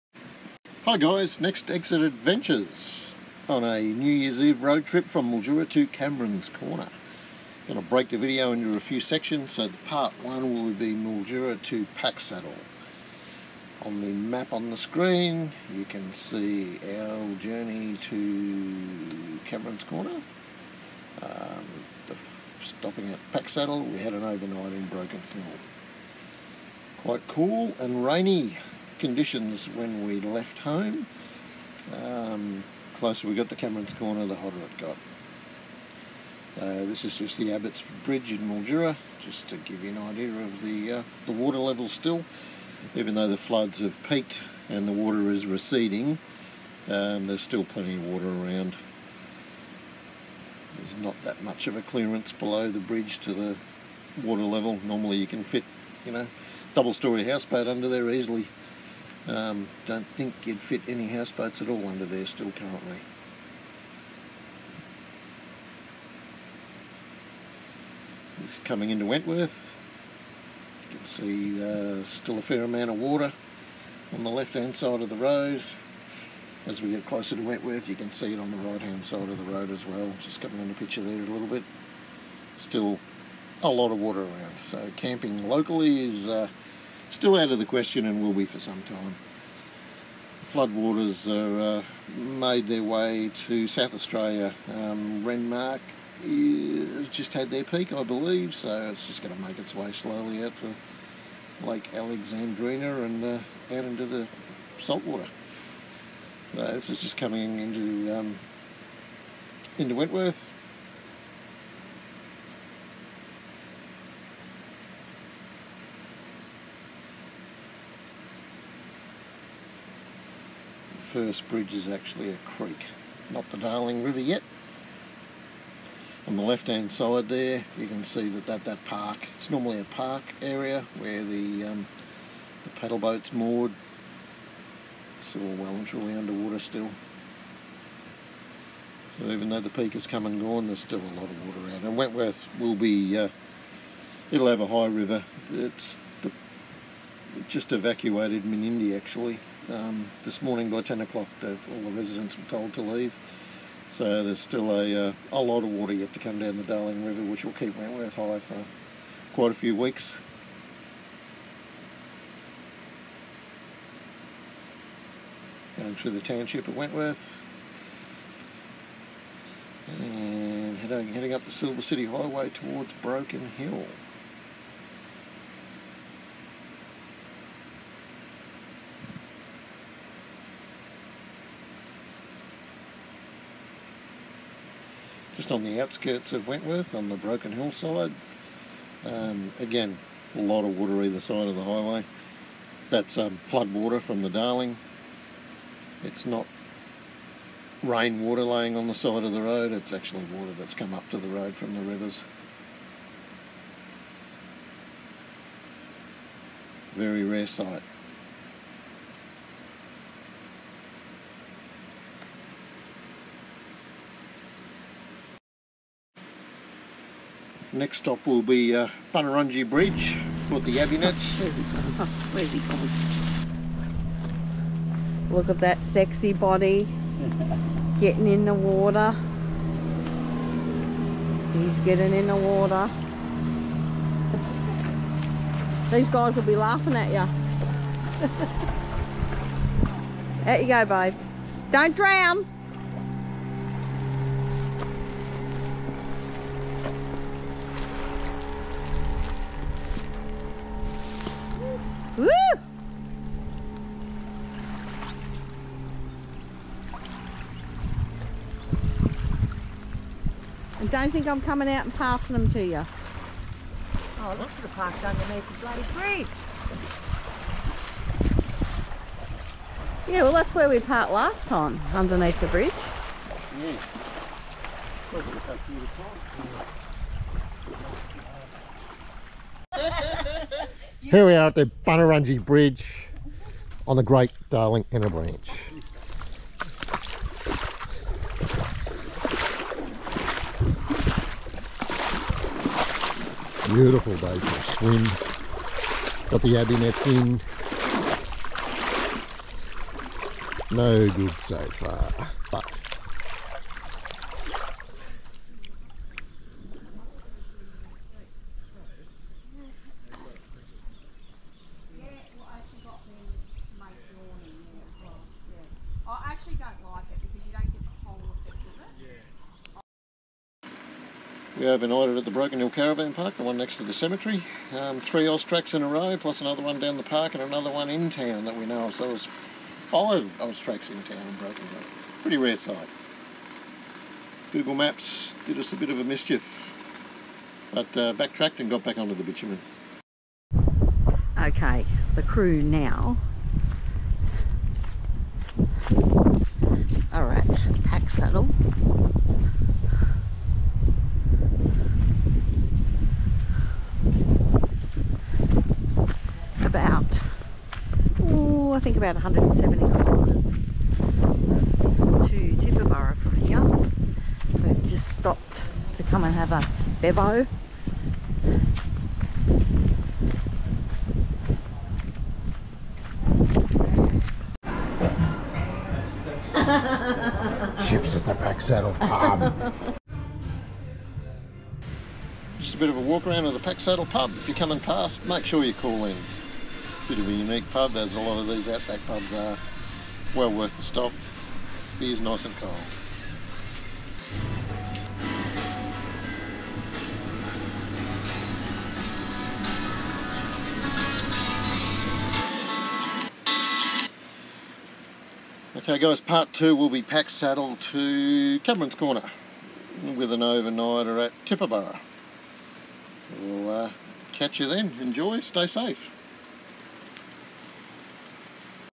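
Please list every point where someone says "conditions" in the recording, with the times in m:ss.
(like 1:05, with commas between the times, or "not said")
0:29.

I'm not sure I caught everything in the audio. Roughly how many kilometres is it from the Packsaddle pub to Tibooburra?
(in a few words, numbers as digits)
170 kilometres.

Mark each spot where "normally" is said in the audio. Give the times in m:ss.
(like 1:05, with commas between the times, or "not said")
0:54, 2:09.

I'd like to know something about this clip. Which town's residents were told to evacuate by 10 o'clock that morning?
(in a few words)
Menindee.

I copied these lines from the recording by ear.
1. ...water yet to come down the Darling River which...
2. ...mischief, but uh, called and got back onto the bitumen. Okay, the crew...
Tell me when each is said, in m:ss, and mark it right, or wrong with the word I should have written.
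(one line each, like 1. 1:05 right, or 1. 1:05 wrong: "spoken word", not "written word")
1. 2:35 right
2. 5:36 wrong: "backtracked", not "called".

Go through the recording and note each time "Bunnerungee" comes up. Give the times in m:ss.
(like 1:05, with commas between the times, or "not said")
3:39, 4:41.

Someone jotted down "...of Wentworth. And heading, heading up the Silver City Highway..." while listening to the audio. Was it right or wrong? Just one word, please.
right.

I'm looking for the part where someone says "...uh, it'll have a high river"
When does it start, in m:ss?
2:23.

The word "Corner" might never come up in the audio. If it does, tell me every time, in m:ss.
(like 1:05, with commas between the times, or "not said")
0:06, 0:19, 0:33, 6:48.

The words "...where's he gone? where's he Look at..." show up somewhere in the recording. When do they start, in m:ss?
3:42.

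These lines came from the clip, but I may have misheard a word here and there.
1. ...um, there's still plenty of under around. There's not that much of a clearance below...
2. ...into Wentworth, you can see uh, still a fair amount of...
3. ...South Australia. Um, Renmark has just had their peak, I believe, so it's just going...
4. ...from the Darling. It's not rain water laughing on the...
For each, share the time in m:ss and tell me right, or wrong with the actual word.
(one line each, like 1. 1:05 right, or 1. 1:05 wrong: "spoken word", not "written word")
1. 0:46 wrong: "water", not "under"
2. 1:08 right
3. 1:33 right
4. 3:13 wrong: "laying", not "laughing".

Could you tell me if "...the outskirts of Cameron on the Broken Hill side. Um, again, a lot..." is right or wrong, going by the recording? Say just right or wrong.
wrong.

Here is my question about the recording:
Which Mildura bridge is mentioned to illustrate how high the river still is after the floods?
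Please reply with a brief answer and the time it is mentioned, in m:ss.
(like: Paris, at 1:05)
Abbotsford Bridge, at 0:37.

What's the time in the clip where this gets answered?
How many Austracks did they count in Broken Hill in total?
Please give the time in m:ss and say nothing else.
5:29.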